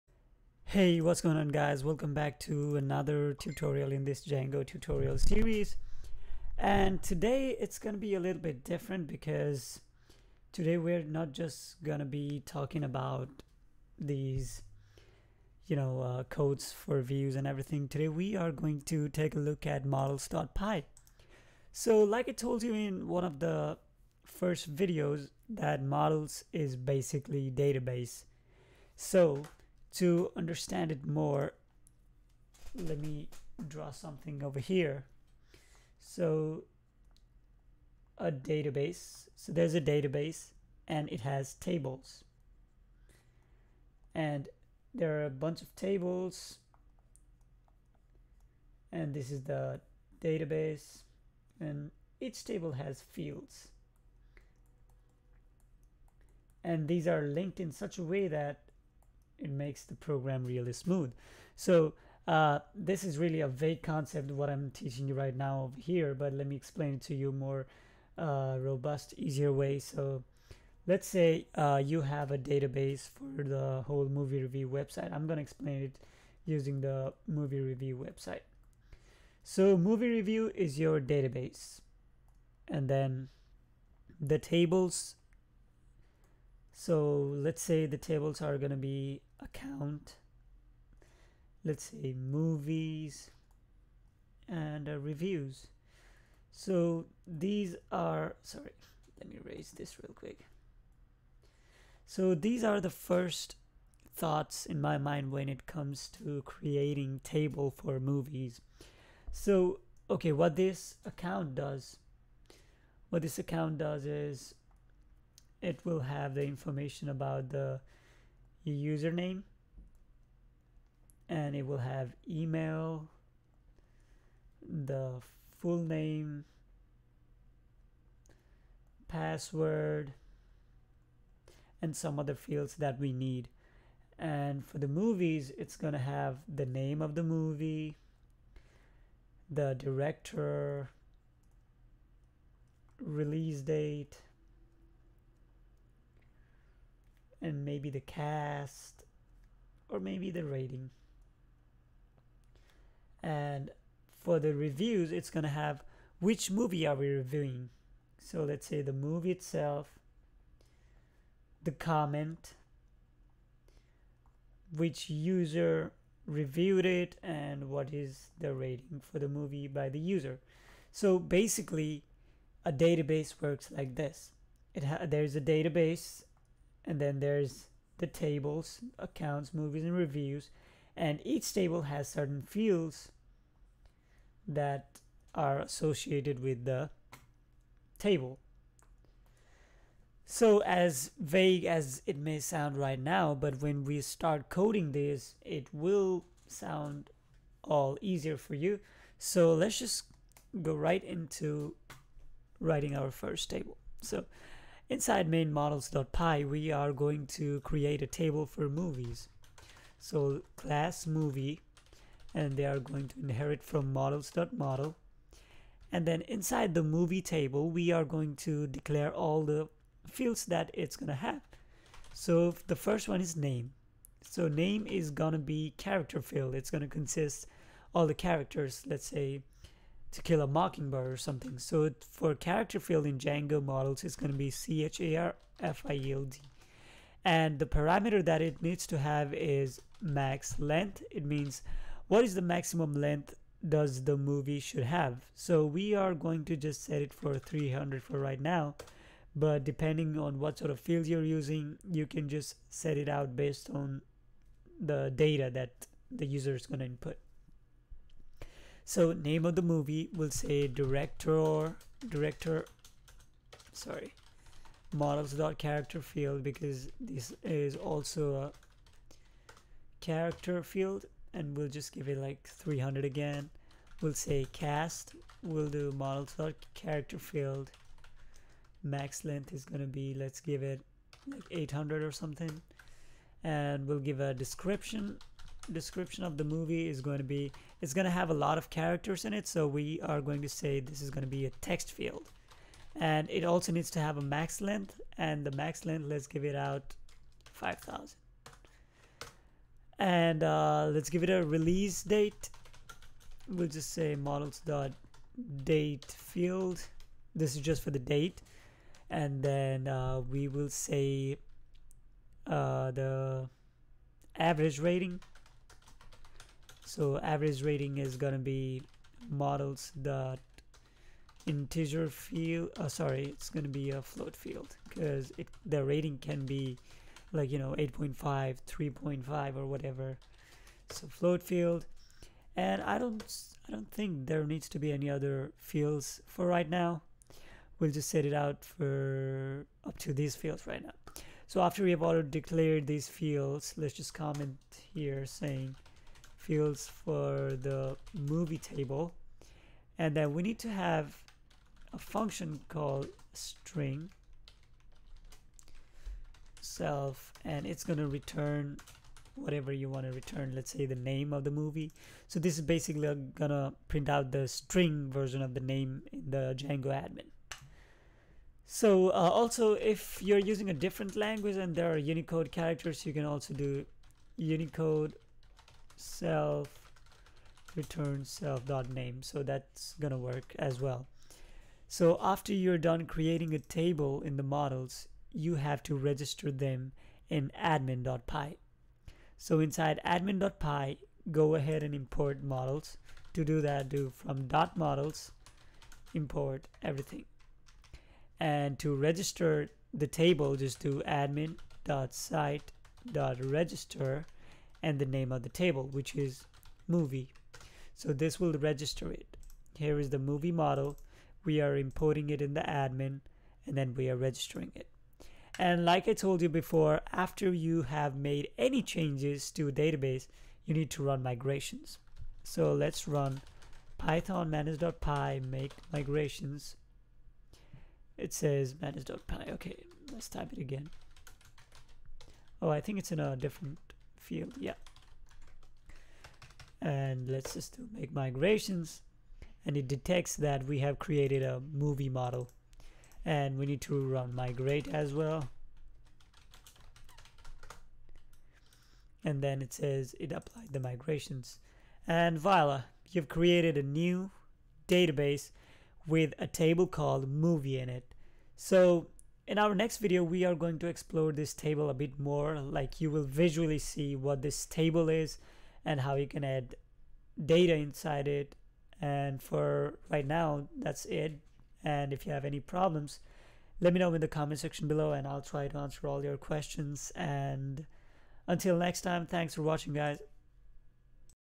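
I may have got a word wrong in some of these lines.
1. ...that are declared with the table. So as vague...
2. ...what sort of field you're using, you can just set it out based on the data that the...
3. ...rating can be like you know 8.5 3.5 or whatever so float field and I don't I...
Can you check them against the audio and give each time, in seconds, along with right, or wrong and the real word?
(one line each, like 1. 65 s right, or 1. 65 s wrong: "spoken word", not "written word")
1. 184 s wrong: "associated", not "declared"
2. 250 s right
3. 325 s right.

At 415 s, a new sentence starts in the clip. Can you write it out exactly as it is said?
And like I told you before, after you have made any changes to a database, you need to run migrations.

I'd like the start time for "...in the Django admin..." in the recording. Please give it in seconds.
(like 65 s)
366 s.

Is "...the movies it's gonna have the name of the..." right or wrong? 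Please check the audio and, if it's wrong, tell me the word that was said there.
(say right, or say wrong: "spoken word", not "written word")
right.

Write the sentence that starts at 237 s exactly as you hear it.
And the parameter that it needs to have is max length.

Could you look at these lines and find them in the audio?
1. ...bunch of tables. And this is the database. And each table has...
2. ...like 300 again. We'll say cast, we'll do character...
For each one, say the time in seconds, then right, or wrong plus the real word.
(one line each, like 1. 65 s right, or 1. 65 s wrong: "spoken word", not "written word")
1. 45 s right
2. 272 s right.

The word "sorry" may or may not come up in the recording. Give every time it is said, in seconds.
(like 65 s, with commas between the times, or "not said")
98 s, 263 s, 322 s.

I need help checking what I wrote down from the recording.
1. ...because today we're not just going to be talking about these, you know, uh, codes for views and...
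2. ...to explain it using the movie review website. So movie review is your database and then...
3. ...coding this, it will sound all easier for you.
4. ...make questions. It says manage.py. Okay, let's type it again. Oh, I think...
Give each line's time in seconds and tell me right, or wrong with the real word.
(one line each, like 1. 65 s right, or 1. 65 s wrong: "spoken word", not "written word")
1. 9 s right
2. 75 s right
3. 194 s right
4. 425 s wrong: "migrations", not "questions".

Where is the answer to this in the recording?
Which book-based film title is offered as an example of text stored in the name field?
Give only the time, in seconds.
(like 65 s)
230 s.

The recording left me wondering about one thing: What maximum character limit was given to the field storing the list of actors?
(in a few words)
800.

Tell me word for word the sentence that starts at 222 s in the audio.
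So the first one is name.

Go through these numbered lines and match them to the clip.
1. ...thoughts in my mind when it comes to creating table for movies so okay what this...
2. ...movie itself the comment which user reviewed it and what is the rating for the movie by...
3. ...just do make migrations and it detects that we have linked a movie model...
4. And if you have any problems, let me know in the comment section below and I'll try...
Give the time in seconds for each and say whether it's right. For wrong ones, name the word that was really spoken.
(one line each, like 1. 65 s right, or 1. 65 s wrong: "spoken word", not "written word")
1. 104 s right
2. 158 s right
3. 437 s wrong: "created", not "linked"
4. 471 s right.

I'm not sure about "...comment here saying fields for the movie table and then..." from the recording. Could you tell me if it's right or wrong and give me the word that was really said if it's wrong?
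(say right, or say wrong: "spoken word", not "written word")
right.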